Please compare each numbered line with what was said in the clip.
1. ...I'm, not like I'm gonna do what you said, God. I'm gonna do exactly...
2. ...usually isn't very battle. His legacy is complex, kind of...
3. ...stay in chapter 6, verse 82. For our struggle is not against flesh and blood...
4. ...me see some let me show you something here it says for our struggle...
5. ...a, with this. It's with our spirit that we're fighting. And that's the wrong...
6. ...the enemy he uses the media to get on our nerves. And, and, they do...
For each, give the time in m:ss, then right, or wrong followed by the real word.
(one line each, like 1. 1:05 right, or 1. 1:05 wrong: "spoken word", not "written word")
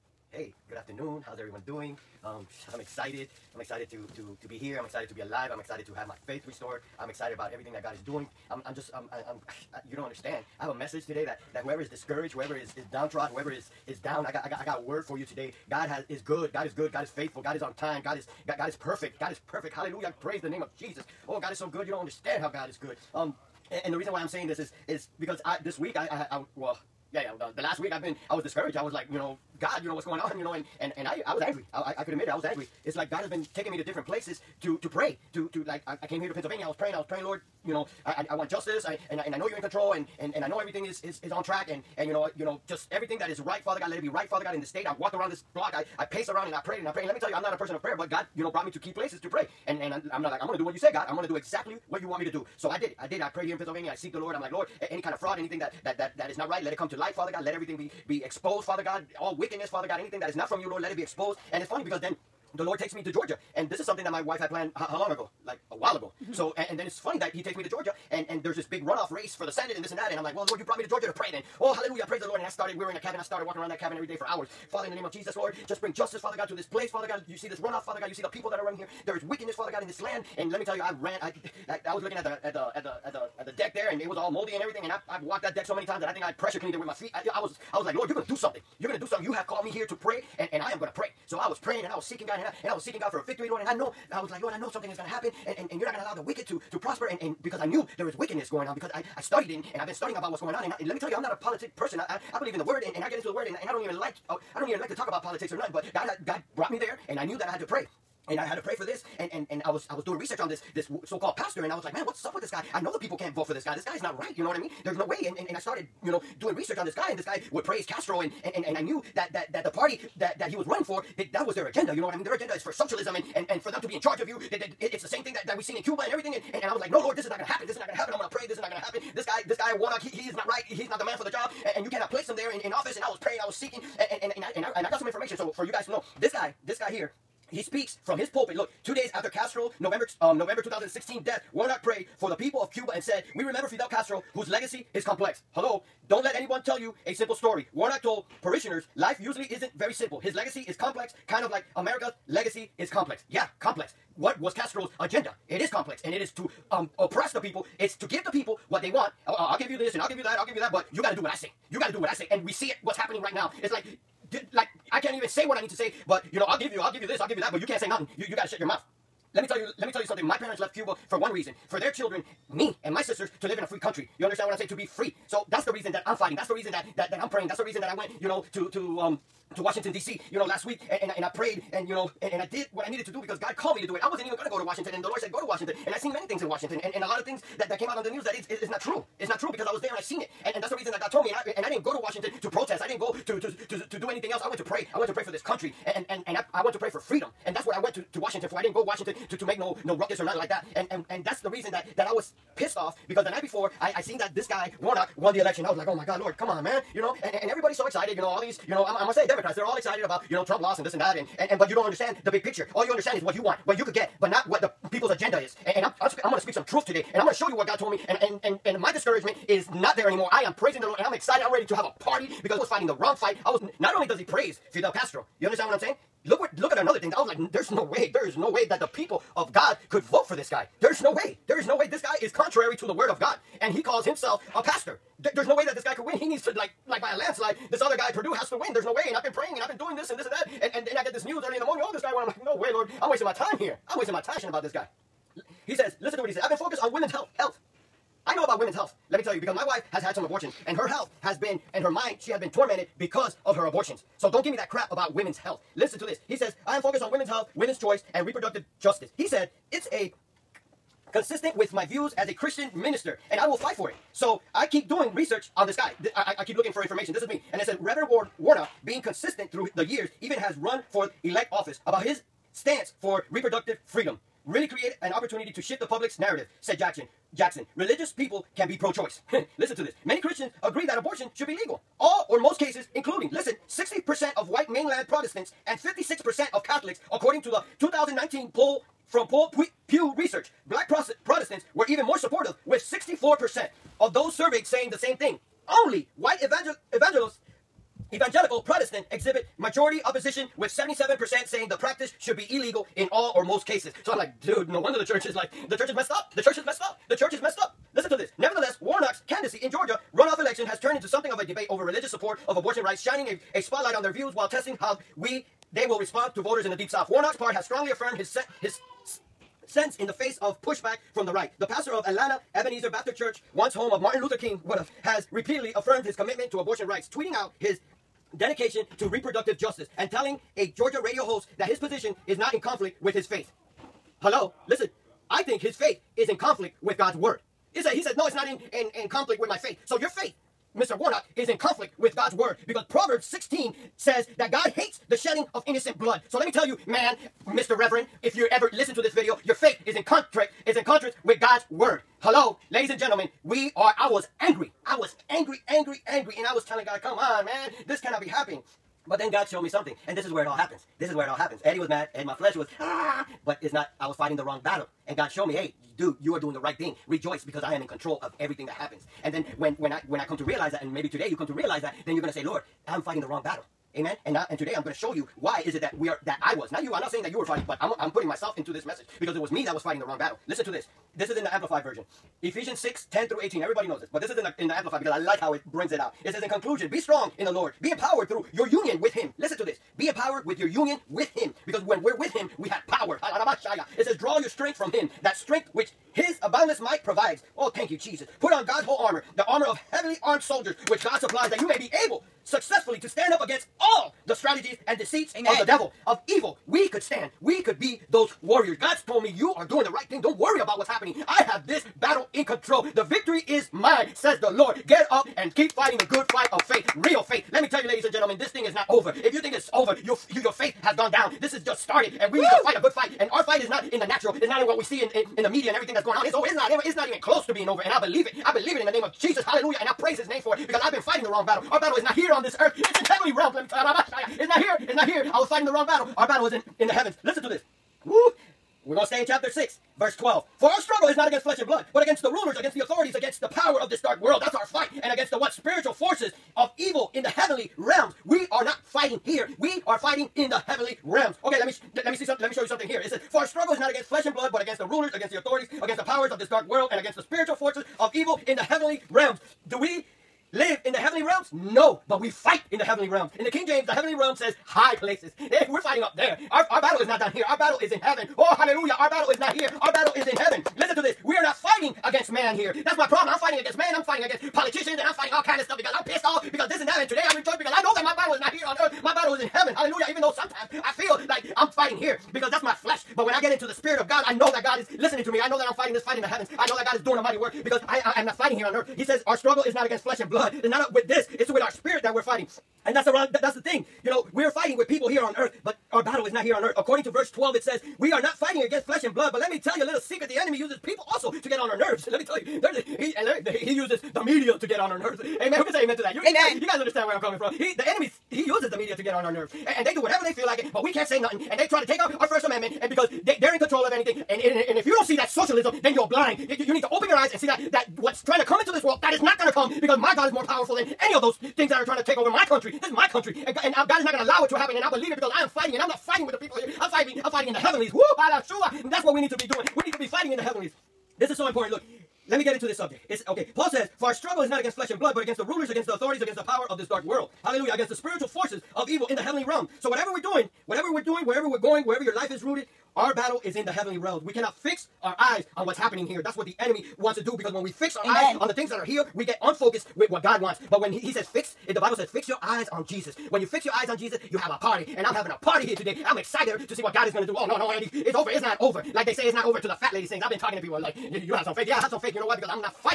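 1. 0:50 right
2. 2:29 wrong: "simple", not "battle"
3. 7:19 wrong: "12", not "82"
4. 7:32 right
5. 8:10 right
6. 8:27 right.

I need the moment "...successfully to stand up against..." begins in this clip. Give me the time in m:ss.
6:42.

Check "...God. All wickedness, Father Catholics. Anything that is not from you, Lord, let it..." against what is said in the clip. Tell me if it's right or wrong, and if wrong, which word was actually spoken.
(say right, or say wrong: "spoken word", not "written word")
wrong: "God", not "Catholics".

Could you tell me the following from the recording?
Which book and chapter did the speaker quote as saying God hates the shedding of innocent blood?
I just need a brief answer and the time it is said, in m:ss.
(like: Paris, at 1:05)
Proverbs 16, at 5:42.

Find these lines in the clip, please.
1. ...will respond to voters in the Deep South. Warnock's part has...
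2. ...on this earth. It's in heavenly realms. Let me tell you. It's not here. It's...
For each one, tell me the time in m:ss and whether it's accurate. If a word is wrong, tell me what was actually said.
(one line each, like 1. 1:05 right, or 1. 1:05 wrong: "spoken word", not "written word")
1. 5:15 right
2. 7:12 right.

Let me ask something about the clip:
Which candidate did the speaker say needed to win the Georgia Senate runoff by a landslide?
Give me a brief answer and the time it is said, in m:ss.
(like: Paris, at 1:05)
Perdue, at 3:58.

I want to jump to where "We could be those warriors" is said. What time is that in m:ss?
6:47.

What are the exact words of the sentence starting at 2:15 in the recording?
So for you guys to know, this guy, this guy here, he speaks from his pulpit.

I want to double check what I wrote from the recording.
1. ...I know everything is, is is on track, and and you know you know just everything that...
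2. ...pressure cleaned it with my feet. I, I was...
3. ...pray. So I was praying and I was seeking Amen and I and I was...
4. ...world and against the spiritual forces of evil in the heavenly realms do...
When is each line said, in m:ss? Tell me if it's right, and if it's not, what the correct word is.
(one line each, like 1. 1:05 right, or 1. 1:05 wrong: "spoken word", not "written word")
1. 0:40 right
2. 1:26 right
3. 1:30 wrong: "God", not "Amen"
4. 7:36 right.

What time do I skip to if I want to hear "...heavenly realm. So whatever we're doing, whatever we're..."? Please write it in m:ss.
8:59.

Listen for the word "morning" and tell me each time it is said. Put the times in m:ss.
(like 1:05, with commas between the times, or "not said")
4:01.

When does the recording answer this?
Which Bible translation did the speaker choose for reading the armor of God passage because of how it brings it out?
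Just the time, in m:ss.
6:21.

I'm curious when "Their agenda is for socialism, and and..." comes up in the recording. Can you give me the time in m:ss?
2:02.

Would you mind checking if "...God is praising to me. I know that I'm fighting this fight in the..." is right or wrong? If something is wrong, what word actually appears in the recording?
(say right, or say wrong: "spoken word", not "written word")
wrong: "listening", not "praising".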